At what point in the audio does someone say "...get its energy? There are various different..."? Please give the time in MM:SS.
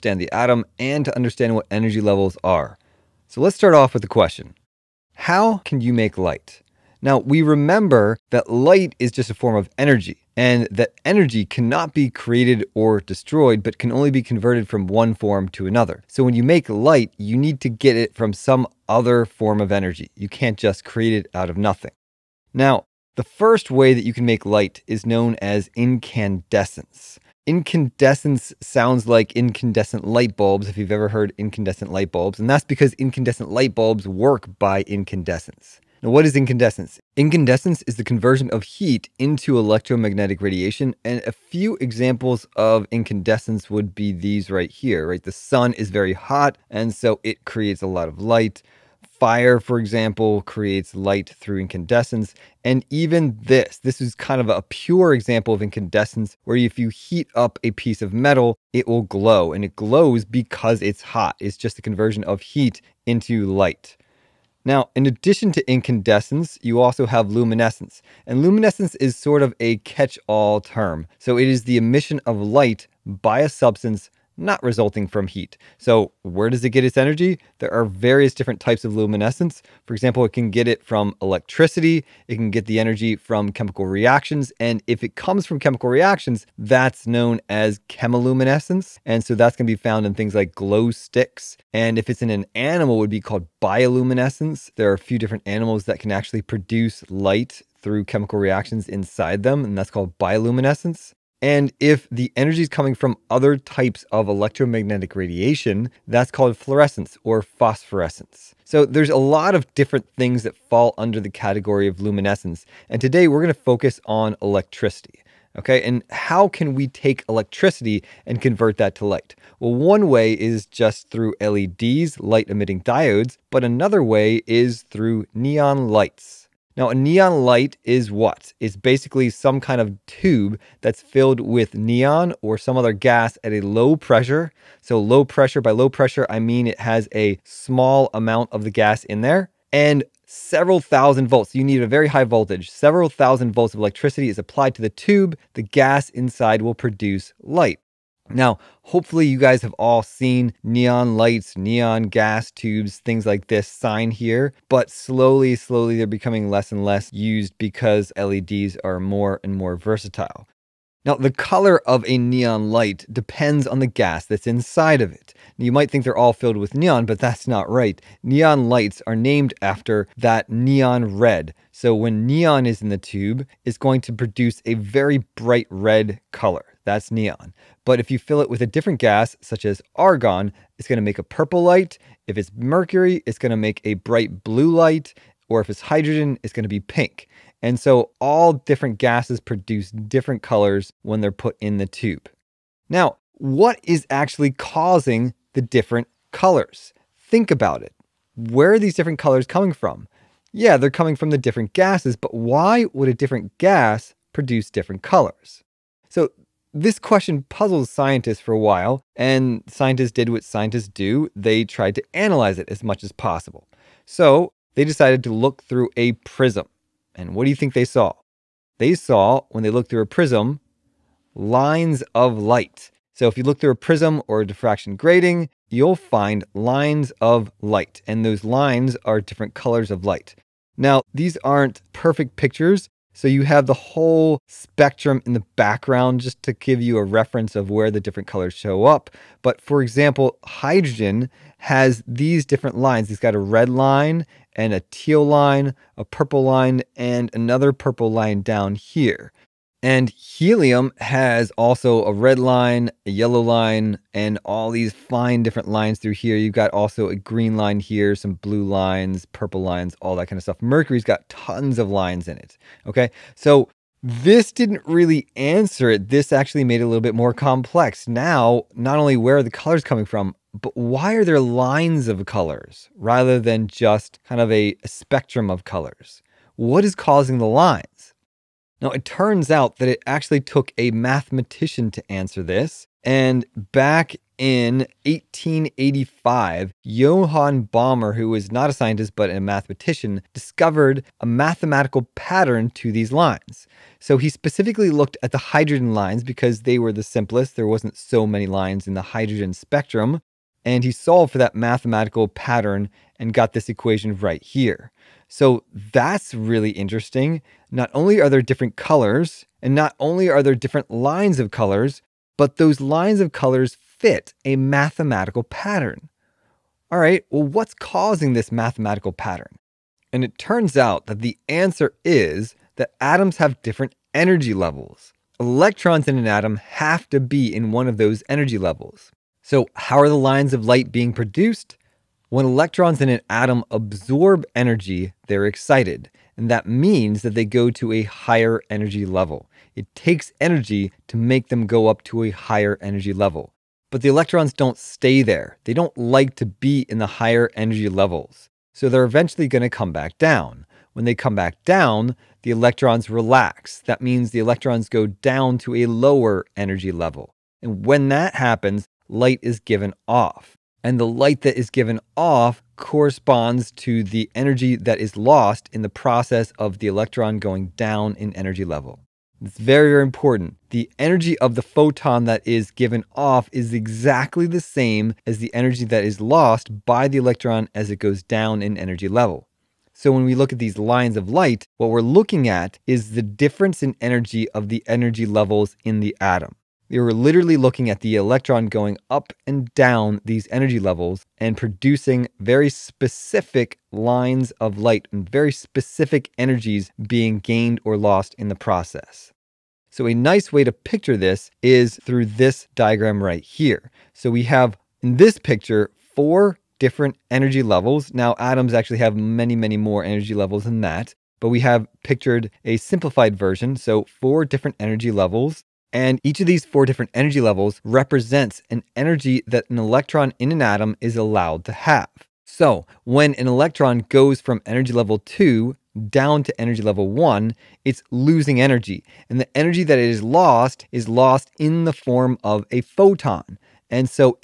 01:16.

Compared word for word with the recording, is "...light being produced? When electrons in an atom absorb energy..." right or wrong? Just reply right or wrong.
right.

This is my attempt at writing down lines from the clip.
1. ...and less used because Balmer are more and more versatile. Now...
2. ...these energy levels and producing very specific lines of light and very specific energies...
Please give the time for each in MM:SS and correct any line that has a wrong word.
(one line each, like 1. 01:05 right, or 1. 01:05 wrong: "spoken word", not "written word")
1. 02:36 wrong: "LEDs", not "Balmer"
2. 06:30 right.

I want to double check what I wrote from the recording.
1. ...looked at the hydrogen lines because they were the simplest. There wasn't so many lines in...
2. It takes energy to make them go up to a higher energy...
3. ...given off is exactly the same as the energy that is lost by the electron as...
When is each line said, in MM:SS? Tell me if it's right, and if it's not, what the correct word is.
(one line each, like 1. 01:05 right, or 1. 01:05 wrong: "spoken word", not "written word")
1. 04:54 right
2. 05:39 right
3. 06:12 right.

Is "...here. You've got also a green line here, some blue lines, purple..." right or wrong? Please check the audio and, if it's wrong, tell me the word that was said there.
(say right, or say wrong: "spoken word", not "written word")
right.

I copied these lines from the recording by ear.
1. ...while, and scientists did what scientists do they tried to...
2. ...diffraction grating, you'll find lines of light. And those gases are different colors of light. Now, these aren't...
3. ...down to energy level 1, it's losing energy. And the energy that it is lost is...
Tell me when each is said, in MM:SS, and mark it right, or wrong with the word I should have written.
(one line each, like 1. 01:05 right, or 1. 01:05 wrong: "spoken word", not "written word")
1. 03:28 right
2. 03:44 wrong: "lines", not "gases"
3. 07:06 right.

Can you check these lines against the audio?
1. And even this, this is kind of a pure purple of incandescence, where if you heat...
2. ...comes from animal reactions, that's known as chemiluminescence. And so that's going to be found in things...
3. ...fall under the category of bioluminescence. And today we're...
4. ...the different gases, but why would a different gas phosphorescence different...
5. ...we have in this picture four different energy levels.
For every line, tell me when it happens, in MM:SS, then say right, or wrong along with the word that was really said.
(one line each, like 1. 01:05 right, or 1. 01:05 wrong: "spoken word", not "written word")
1. 00:52 wrong: "example", not "purple"
2. 01:25 wrong: "chemical", not "animal"
3. 01:50 wrong: "luminescence", not "bioluminescence"
4. 03:21 wrong: "produce", not "phosphorescence"
5. 06:44 right.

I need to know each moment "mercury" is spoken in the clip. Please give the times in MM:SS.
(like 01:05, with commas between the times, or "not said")
03:02, 04:20.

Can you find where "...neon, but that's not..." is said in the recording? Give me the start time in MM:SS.
02:46.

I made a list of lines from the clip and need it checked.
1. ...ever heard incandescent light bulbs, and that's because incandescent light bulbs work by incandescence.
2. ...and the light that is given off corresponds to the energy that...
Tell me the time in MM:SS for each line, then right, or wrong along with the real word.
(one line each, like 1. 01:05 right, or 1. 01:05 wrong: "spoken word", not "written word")
1. 00:30 right
2. 06:00 right.